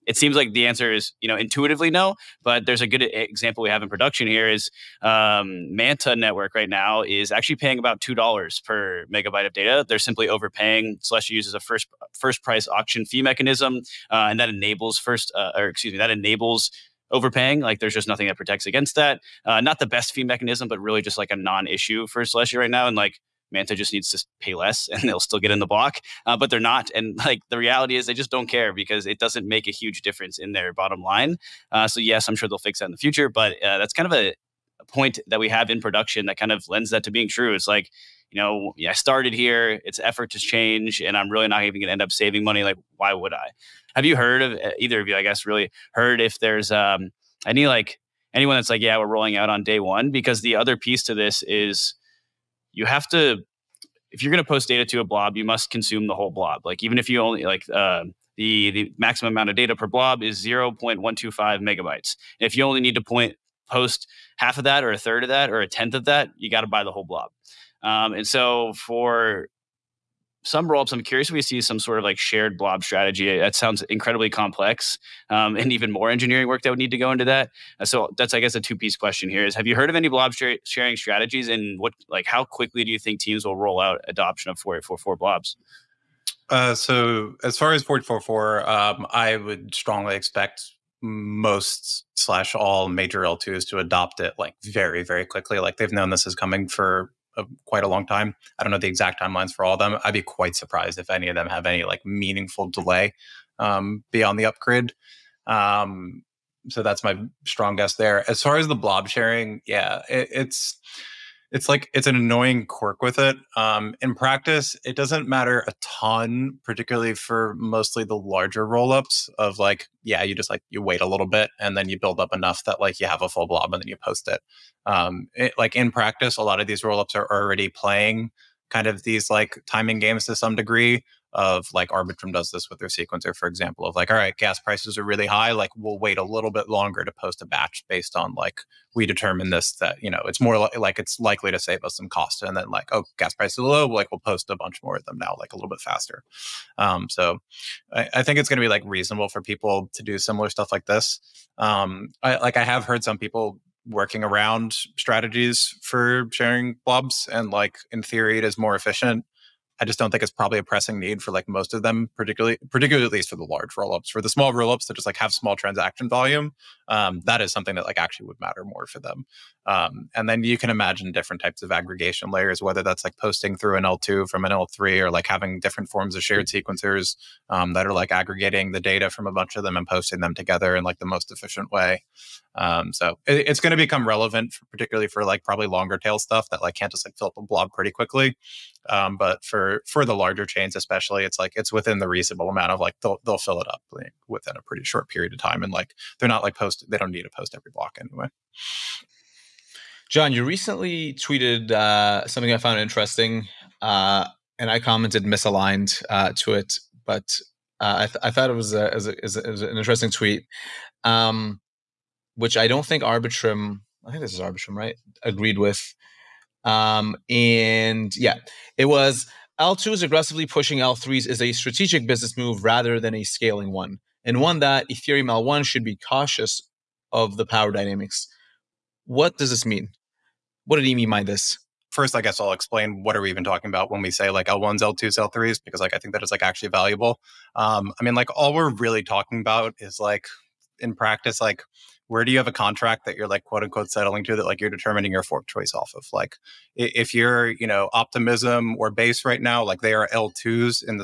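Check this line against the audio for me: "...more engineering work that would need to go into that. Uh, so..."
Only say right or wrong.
right.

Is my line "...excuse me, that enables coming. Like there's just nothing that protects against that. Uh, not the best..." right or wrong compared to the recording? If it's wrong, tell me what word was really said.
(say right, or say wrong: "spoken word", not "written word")
wrong: "overpaying", not "coming".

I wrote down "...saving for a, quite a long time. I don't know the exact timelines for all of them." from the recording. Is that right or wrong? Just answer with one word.
wrong.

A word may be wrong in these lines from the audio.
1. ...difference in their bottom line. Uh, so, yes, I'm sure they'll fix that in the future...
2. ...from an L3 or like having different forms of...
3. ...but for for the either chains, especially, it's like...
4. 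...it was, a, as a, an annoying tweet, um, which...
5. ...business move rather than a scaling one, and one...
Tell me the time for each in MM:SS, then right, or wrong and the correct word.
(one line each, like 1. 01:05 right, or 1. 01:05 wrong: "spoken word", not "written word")
1. 00:30 right
2. 02:54 right
3. 03:09 wrong: "larger", not "either"
4. 03:28 wrong: "interesting", not "annoying"
5. 03:42 right.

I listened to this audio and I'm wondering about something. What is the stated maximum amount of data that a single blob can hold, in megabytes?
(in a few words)
0.125 megabytes.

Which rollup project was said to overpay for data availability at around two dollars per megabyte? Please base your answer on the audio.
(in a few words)
Manta Network.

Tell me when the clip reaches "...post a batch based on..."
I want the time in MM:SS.
02:17.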